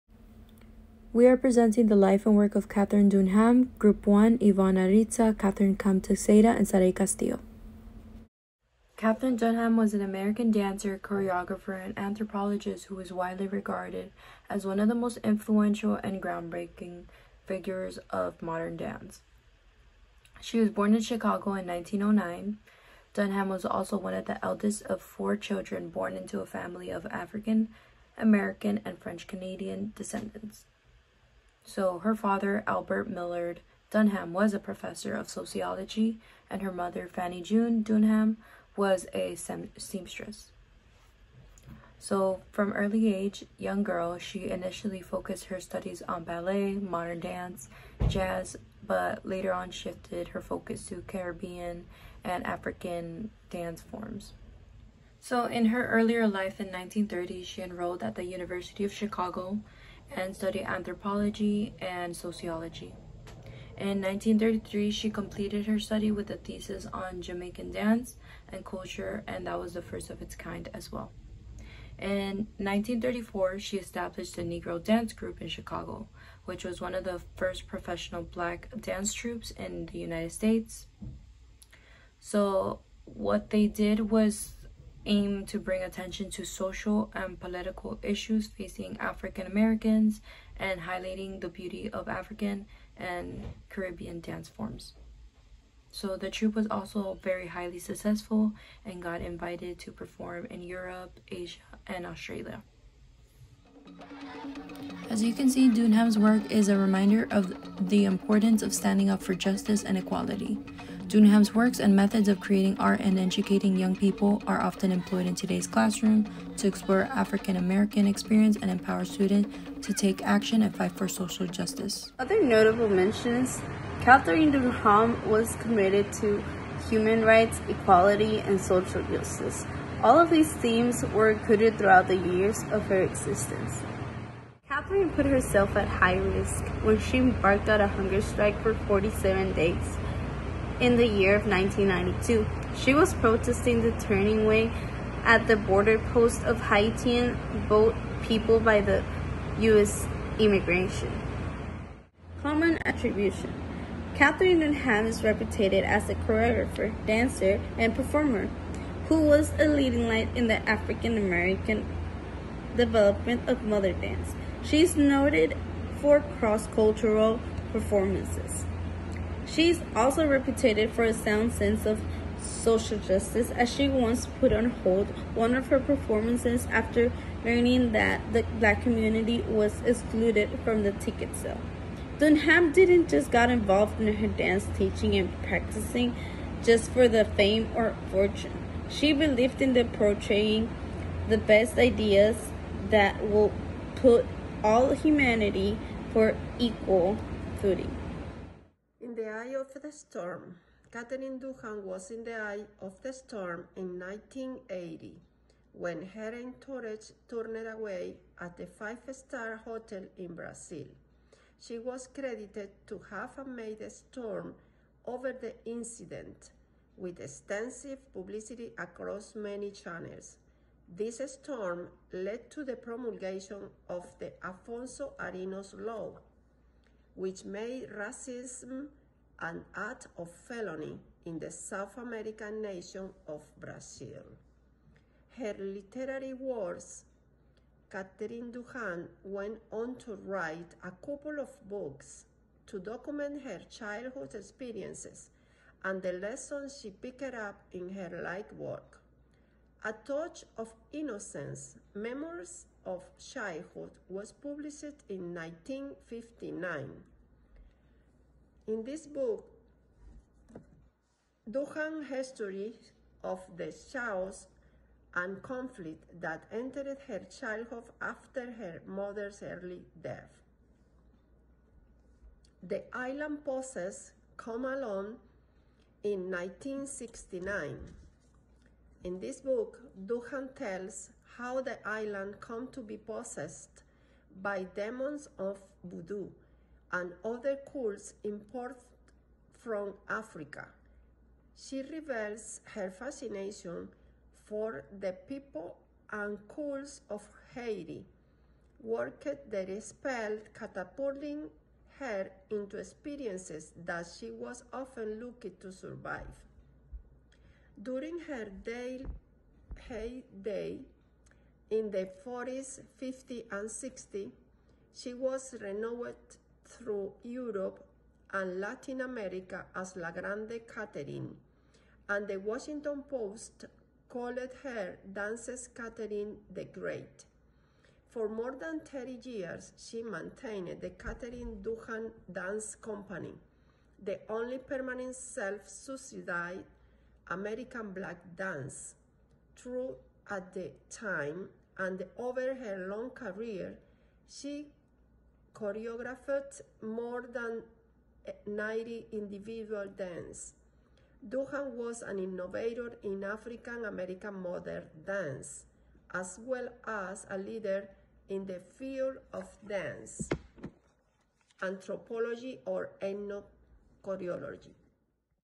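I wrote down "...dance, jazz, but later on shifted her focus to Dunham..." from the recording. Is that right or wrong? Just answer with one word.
wrong.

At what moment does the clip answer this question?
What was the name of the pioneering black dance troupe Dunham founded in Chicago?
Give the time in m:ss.
1:14.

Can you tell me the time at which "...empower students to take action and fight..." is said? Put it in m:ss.
1:58.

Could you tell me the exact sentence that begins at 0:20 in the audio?
She was born in Chicago in 1909.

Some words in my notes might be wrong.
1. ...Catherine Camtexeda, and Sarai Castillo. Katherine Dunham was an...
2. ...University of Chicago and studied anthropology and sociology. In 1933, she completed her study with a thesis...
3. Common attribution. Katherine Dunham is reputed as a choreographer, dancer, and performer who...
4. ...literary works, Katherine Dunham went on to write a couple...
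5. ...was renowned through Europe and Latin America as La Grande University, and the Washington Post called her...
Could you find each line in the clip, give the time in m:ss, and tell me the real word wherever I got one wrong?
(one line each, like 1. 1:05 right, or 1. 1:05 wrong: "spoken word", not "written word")
1. 0:05 right
2. 0:58 right
3. 2:32 right
4. 3:55 right
5. 5:15 wrong: "Katherine", not "University".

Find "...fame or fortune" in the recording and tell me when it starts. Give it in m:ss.
3:07.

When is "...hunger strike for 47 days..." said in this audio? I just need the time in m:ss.
2:17.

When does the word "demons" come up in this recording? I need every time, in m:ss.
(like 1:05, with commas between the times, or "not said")
4:44.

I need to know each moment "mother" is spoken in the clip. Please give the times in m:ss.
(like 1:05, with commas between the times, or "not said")
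0:36, 4:28.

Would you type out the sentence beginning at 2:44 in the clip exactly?
She is noted for cross-cultural performances.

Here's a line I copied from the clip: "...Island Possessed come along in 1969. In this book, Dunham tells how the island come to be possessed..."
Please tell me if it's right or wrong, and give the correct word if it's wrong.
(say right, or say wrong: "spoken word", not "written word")
right.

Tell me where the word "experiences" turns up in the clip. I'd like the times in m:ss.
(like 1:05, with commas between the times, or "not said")
1:58, 4:04, 5:02.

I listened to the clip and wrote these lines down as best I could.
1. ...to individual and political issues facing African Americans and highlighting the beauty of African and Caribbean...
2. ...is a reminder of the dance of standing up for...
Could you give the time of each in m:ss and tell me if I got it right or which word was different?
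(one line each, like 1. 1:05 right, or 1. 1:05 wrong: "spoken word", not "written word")
1. 1:26 wrong: "social", not "individual"
2. 1:46 wrong: "importance", not "dance".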